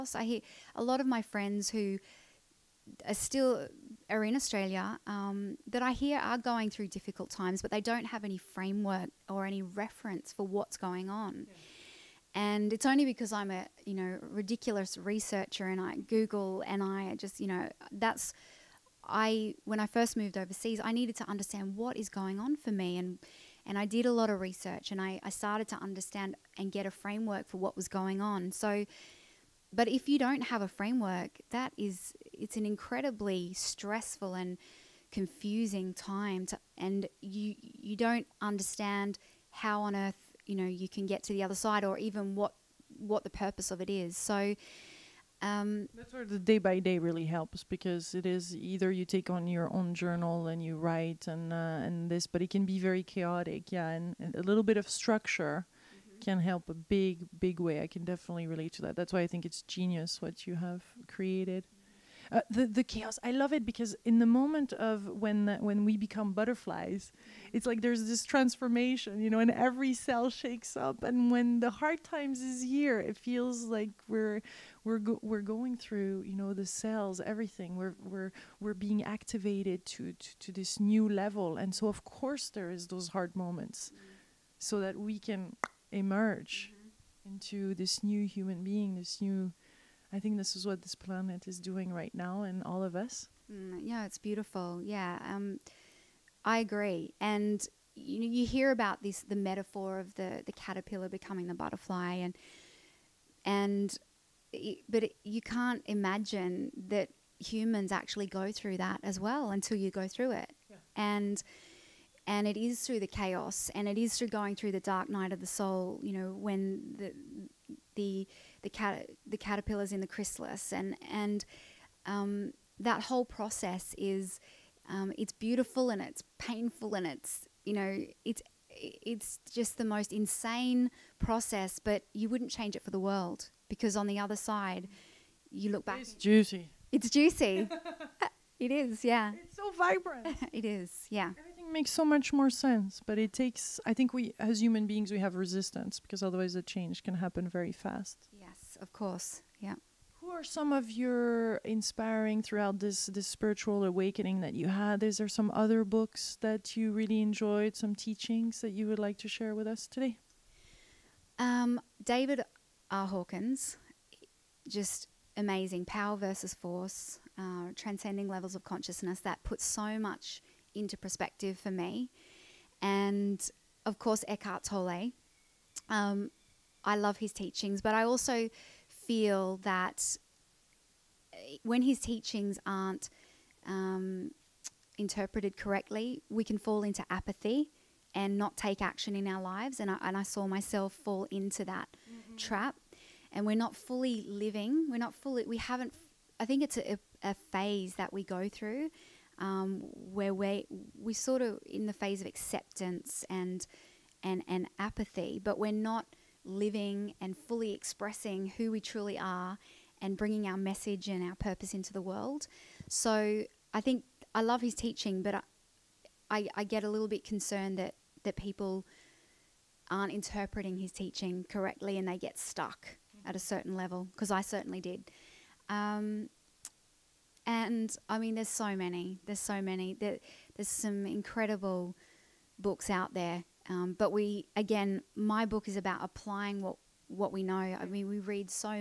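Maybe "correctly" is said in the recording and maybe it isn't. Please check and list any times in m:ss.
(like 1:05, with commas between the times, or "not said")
3:05, 3:41.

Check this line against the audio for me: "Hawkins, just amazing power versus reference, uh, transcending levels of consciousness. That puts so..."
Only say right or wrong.
wrong.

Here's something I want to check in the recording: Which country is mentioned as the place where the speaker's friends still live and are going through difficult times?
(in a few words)
Australia.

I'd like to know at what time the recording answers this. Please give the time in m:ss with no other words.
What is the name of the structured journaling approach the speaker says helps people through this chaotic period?
0:46.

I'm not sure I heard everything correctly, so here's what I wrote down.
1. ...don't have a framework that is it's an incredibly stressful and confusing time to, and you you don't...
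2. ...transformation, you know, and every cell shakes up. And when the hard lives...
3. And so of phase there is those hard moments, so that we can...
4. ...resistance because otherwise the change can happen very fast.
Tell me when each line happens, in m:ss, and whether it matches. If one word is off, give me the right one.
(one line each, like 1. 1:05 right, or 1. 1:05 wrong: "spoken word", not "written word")
1. 0:30 right
2. 1:08 wrong: "times", not "lives"
3. 1:21 wrong: "course", not "phase"
4. 2:25 right.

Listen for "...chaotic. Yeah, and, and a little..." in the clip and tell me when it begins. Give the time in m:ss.
0:53.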